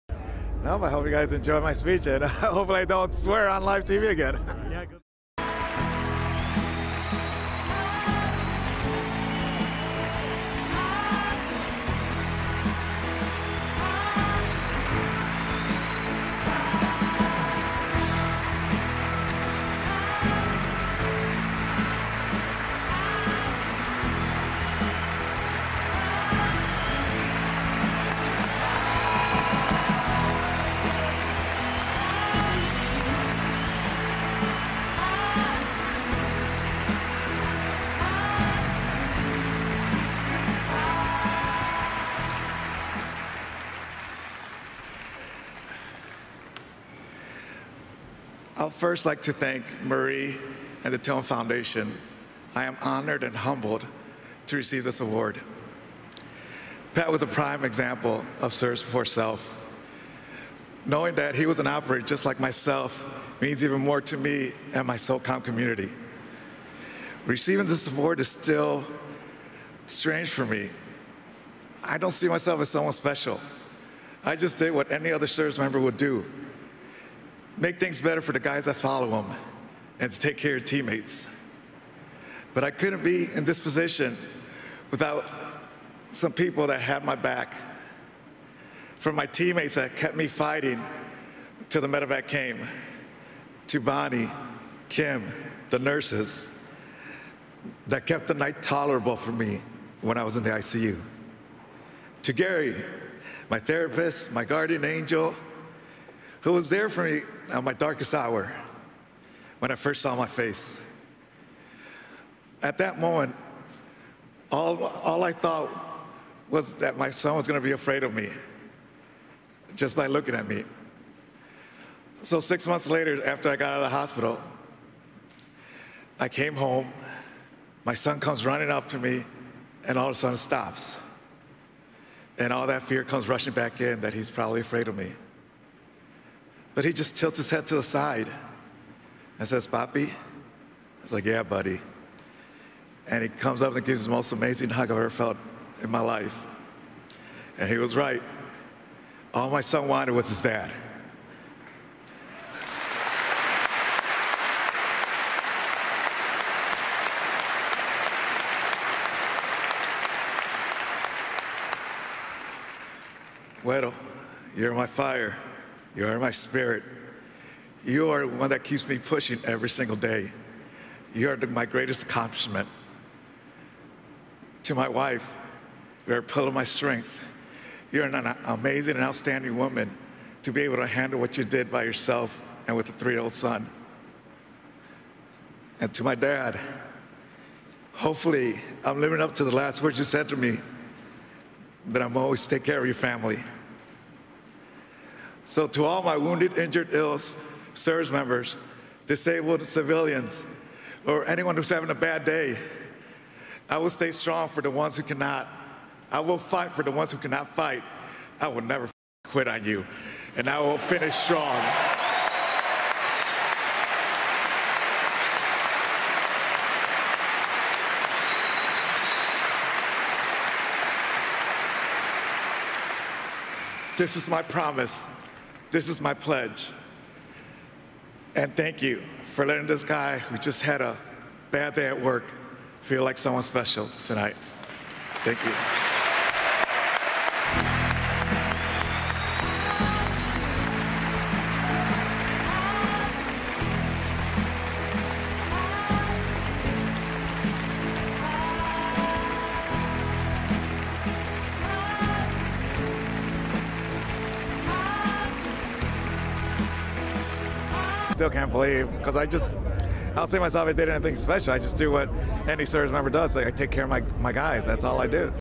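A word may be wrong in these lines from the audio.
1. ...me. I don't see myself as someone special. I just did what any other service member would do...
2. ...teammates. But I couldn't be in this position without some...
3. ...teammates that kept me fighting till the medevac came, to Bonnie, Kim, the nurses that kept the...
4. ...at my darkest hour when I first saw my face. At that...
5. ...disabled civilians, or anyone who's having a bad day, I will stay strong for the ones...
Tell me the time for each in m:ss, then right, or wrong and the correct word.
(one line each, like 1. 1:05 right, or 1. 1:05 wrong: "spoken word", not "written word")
1. 1:10 right
2. 1:20 right
3. 1:29 right
4. 1:47 right
5. 3:19 right.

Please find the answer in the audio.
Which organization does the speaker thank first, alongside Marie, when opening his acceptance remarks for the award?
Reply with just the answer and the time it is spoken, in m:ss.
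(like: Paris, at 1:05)
Tone Foundation, at 0:50.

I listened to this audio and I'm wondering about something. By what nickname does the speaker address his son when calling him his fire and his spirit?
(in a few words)
Güero.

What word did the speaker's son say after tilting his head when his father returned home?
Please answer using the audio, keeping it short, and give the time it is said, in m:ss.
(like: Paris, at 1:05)
Papi, at 2:19.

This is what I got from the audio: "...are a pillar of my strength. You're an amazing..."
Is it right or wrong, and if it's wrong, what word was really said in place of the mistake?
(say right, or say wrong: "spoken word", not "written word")
right.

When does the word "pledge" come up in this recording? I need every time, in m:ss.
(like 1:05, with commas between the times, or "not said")
3:46.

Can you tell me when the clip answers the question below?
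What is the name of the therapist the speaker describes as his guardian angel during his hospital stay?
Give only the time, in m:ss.
1:42.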